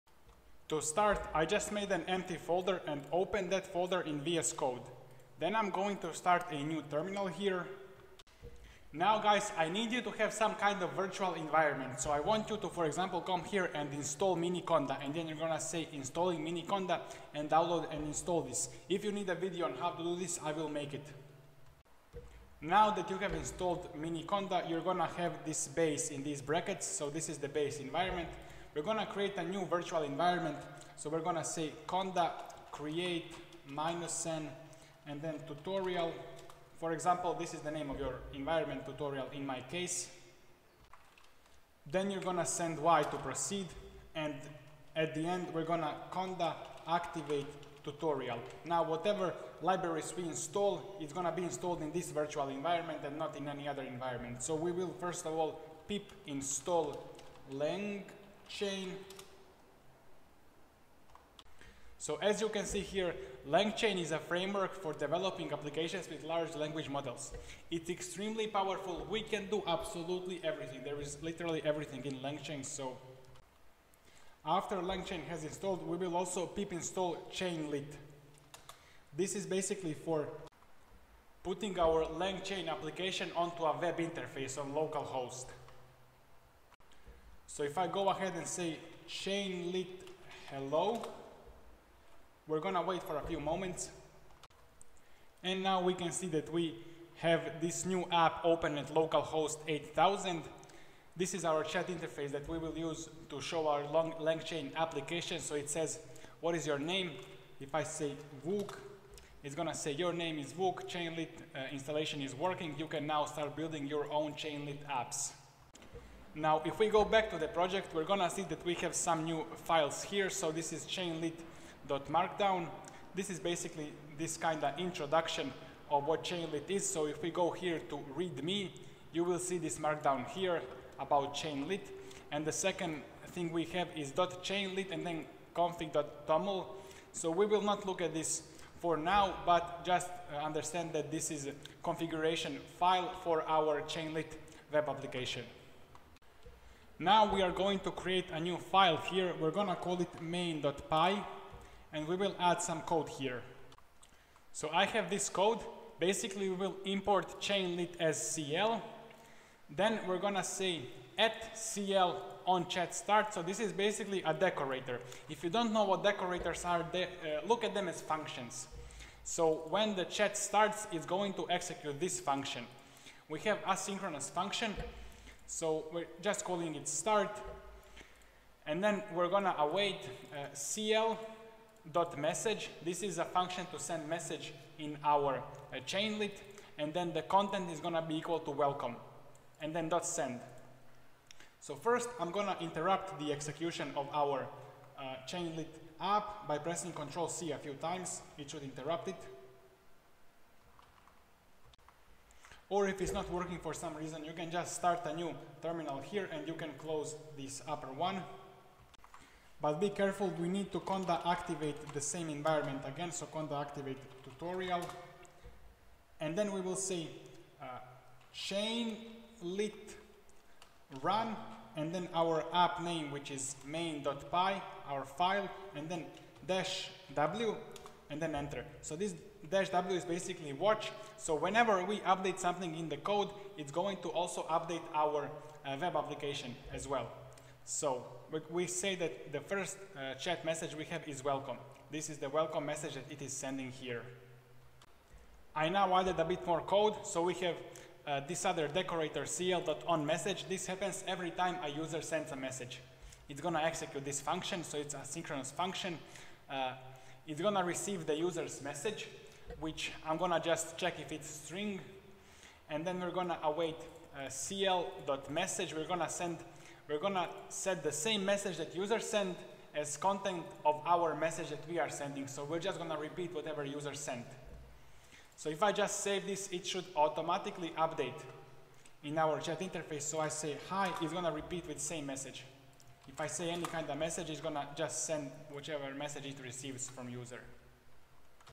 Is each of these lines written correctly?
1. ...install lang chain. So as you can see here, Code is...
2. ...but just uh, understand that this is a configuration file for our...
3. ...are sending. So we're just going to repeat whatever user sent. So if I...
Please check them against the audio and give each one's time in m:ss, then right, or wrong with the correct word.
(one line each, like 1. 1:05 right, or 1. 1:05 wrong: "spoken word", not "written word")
1. 0:56 wrong: "LangChain", not "Code"
2. 2:19 right
3. 4:31 right.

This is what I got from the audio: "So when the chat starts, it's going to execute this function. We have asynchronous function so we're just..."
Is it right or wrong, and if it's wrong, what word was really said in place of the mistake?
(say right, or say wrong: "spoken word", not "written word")
right.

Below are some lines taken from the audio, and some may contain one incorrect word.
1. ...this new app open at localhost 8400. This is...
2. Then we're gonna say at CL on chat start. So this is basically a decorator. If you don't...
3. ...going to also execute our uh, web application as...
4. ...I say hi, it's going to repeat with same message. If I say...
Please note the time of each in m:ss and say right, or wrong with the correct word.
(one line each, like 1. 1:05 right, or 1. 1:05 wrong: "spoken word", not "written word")
1. 1:37 wrong: "8000", not "8400"
2. 2:39 right
3. 3:53 wrong: "update", not "execute"
4. 4:40 right.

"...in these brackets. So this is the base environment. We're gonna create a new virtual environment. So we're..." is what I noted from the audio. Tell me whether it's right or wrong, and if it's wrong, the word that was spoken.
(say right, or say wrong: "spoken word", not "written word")
right.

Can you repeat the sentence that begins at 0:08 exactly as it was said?
Now guys, I need you to have some kind of virtual environment.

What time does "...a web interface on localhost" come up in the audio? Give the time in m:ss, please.
1:23.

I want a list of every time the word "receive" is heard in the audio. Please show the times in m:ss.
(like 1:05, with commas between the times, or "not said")
4:17, 4:46.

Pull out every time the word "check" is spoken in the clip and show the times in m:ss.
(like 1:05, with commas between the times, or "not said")
4:20.